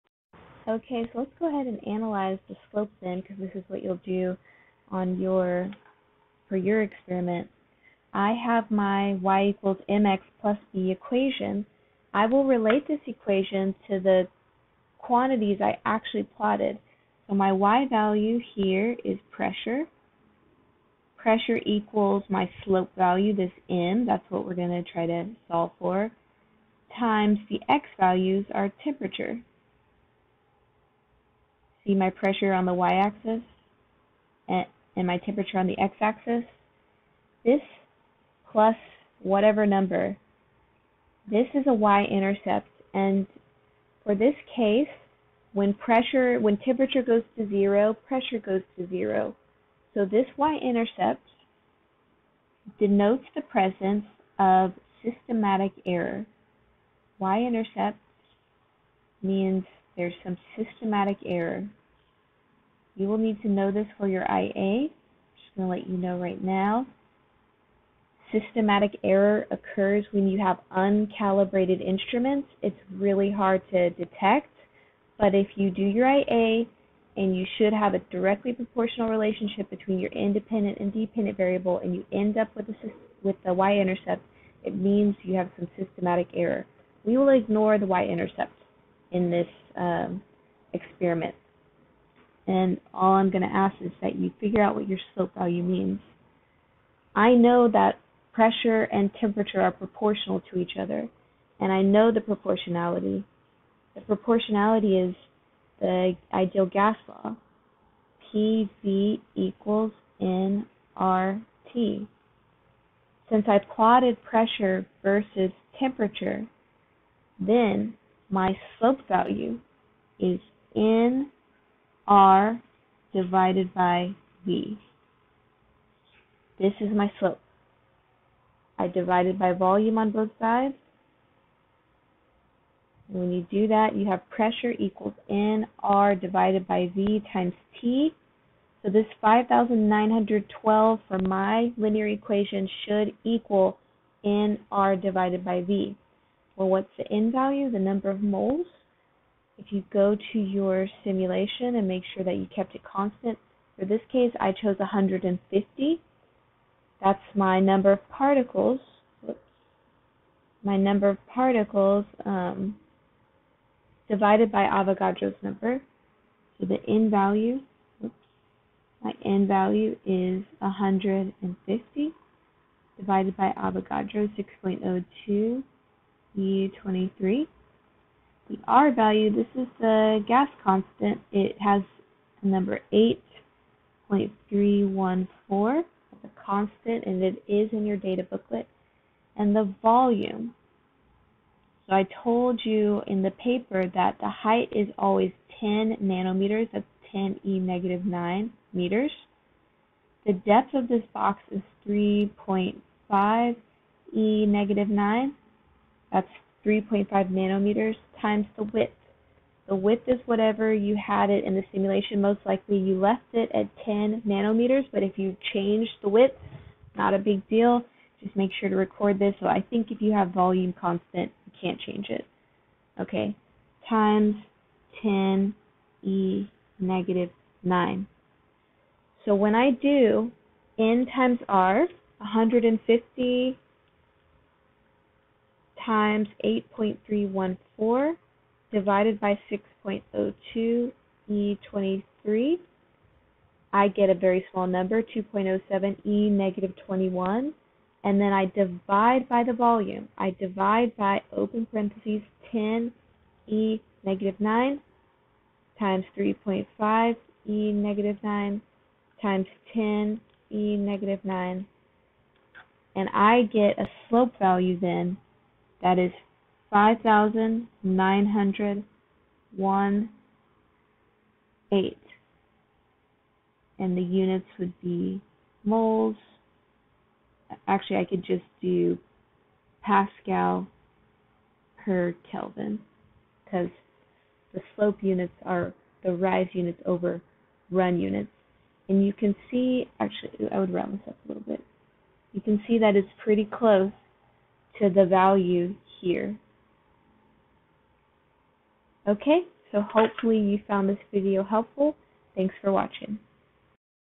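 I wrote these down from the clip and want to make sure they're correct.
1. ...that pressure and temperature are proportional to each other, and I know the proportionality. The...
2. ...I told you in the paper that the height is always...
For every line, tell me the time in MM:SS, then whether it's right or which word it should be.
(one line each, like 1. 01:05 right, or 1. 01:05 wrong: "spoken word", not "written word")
1. 01:37 right
2. 03:11 right.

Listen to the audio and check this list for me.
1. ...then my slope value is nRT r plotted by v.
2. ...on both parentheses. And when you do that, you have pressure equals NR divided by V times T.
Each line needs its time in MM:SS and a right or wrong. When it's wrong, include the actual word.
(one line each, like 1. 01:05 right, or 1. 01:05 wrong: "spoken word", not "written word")
1. 01:57 wrong: "divided", not "plotted"
2. 02:09 wrong: "sides", not "parentheses".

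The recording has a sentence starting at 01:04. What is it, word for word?
Just going to let you know right now.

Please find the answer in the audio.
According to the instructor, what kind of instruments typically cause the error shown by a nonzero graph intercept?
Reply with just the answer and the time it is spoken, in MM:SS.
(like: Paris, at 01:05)
Uncalibrated instruments, at 01:10.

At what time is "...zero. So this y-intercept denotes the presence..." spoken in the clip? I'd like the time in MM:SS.
00:48.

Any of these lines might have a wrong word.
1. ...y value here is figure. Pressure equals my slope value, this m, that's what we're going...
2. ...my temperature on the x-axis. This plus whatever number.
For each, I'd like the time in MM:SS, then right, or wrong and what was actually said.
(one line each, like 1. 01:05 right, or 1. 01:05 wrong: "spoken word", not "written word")
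1. 00:17 wrong: "pressure", not "figure"
2. 00:35 right.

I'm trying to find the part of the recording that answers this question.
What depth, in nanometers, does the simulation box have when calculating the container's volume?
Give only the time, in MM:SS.
03:26.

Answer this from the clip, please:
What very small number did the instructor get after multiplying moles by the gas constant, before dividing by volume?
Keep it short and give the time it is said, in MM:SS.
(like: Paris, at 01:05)
2.07 E-21, at 04:05.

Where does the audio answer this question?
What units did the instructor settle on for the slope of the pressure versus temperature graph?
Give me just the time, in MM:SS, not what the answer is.
04:39.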